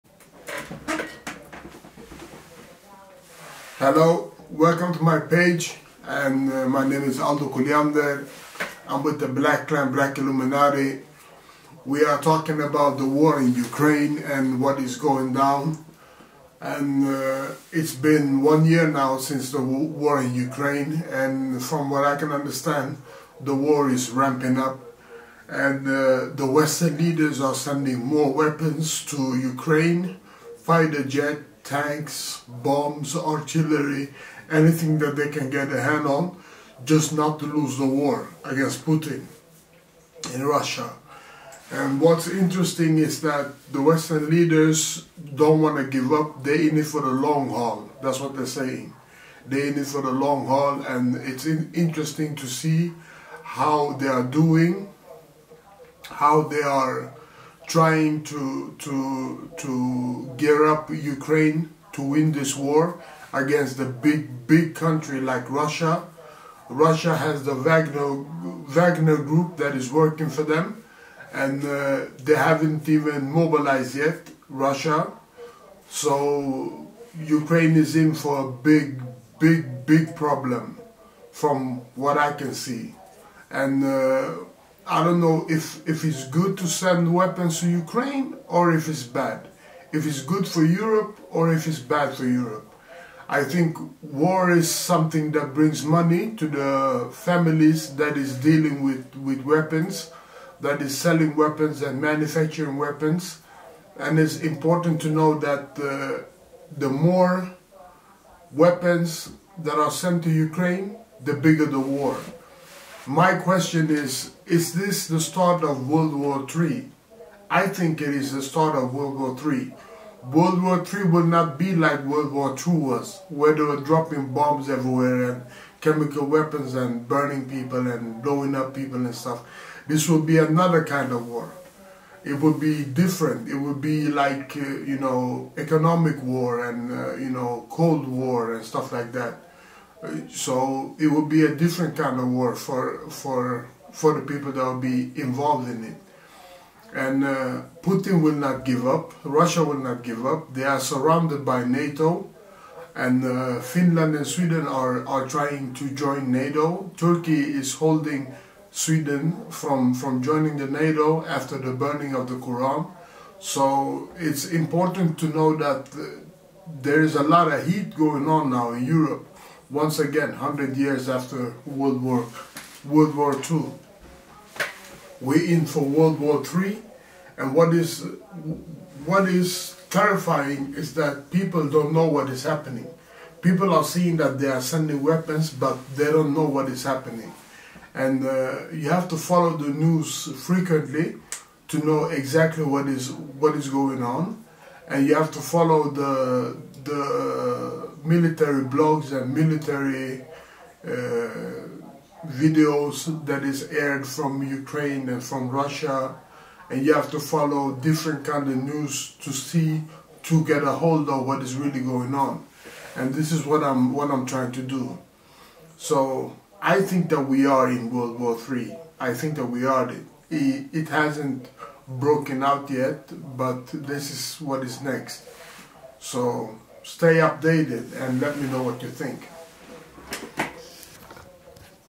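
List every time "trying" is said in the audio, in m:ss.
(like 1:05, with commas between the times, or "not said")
0:57, 2:35, 3:34.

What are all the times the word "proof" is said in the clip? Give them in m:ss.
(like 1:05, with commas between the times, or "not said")
not said.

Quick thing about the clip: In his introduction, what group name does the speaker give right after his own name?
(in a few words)
Black Clan.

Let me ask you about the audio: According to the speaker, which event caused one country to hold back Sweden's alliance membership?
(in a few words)
burning of the Quran.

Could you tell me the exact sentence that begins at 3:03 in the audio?
People are seeing that they are sending weapons, but they don't know what is happening.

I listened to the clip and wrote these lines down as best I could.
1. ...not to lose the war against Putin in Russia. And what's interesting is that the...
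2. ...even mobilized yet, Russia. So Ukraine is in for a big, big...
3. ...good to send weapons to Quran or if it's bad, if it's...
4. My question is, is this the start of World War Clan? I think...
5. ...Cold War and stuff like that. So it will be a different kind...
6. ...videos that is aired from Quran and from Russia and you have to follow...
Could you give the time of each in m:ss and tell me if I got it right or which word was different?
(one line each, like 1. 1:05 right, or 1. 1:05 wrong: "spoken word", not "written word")
1. 0:37 right
2. 1:12 right
3. 1:26 wrong: "Ukraine", not "Quran"
4. 1:53 wrong: "III", not "Clan"
5. 2:17 right
6. 3:22 wrong: "Ukraine", not "Quran".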